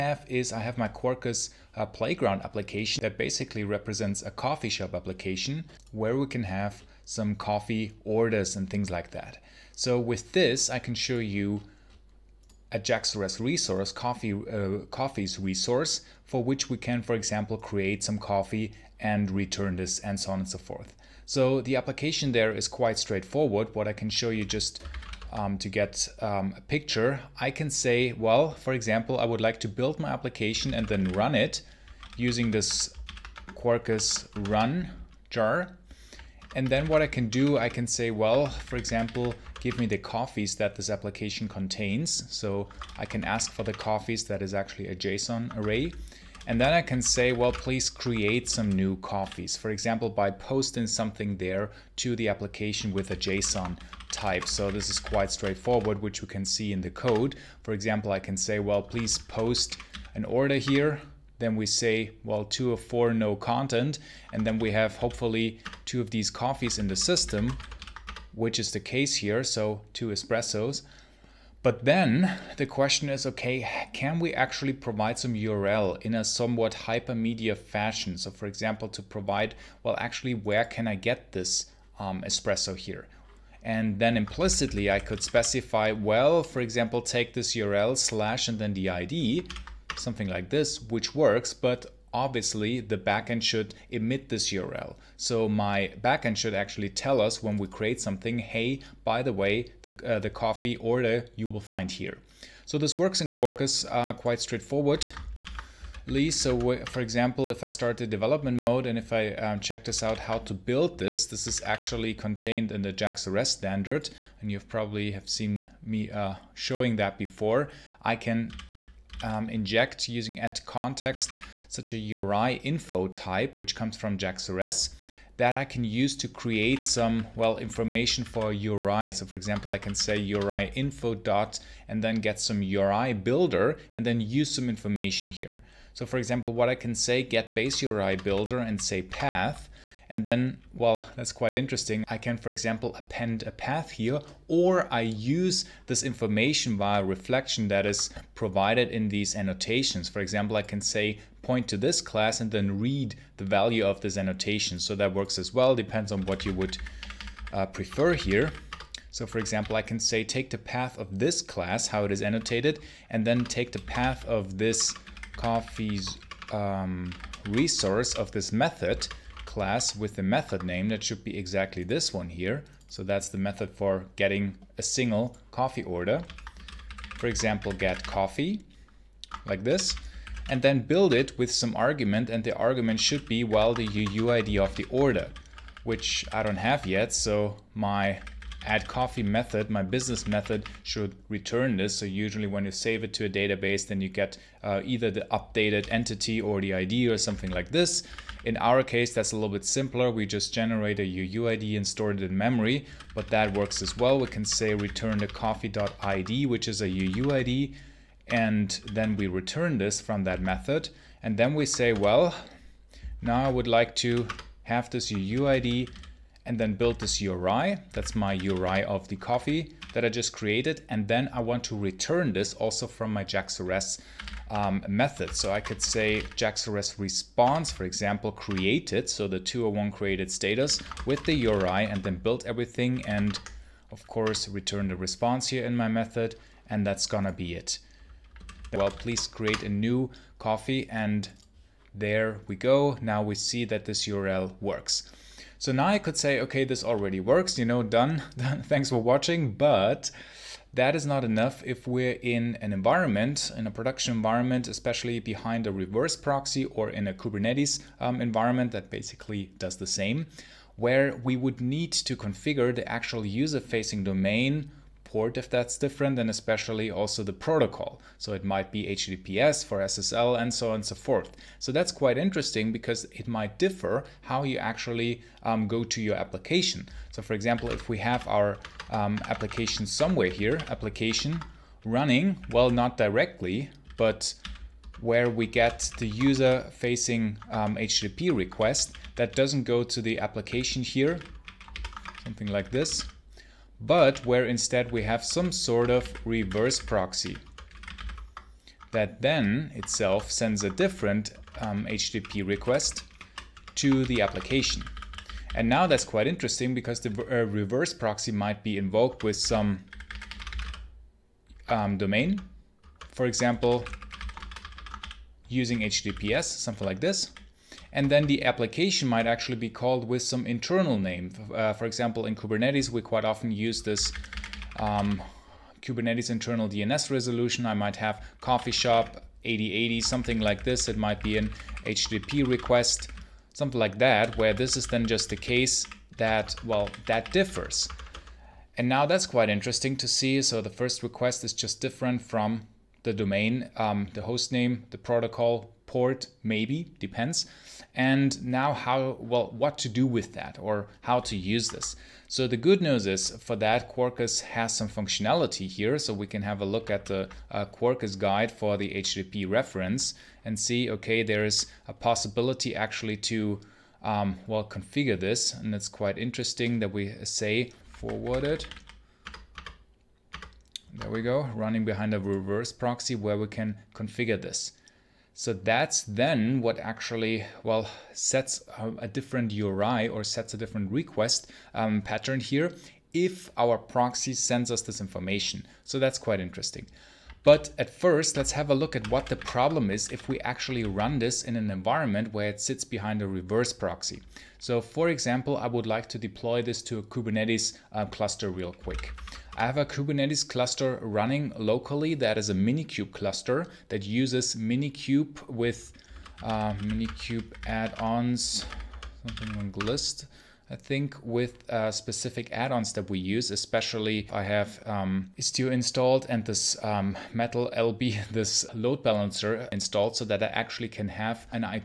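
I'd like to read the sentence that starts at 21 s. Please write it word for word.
So the application there is quite straightforward.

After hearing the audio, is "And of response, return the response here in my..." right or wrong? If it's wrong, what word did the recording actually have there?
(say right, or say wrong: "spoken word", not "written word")
wrong: "course", not "response".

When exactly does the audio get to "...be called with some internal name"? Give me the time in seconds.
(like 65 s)
319 s.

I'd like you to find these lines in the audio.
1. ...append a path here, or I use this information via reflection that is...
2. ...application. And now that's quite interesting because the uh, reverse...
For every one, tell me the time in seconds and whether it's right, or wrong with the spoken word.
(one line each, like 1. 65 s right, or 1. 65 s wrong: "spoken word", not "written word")
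1. 142 s right
2. 304 s right.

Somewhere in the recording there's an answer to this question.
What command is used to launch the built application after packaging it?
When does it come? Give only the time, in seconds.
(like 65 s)
33 s.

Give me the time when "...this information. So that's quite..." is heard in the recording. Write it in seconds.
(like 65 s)
384 s.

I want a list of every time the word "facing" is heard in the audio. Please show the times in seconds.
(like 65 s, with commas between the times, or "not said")
263 s, 286 s.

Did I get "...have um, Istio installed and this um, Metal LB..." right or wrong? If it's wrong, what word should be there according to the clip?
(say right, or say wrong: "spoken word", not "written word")
right.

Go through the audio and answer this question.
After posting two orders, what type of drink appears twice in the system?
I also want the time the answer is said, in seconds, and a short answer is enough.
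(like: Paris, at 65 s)
espresso, at 70 s.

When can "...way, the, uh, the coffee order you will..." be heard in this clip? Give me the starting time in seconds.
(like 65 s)
99 s.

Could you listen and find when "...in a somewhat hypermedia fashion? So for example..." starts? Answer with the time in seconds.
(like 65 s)
76 s.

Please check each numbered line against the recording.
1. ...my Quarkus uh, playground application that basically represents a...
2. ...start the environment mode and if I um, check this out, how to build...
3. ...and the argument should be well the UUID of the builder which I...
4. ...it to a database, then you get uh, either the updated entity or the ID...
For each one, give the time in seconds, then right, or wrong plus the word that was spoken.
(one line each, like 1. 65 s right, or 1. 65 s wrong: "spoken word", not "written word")
1. 0 s right
2. 107 s wrong: "development", not "environment"
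3. 182 s wrong: "order", not "builder"
4. 193 s right.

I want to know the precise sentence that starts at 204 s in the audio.
We can say return the coffee.id, which is a UUID, and then we return this from that method.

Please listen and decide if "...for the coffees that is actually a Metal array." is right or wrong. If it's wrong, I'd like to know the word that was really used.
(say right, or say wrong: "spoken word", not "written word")
wrong: "JSON", not "Metal".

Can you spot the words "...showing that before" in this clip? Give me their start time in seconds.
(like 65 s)
116 s.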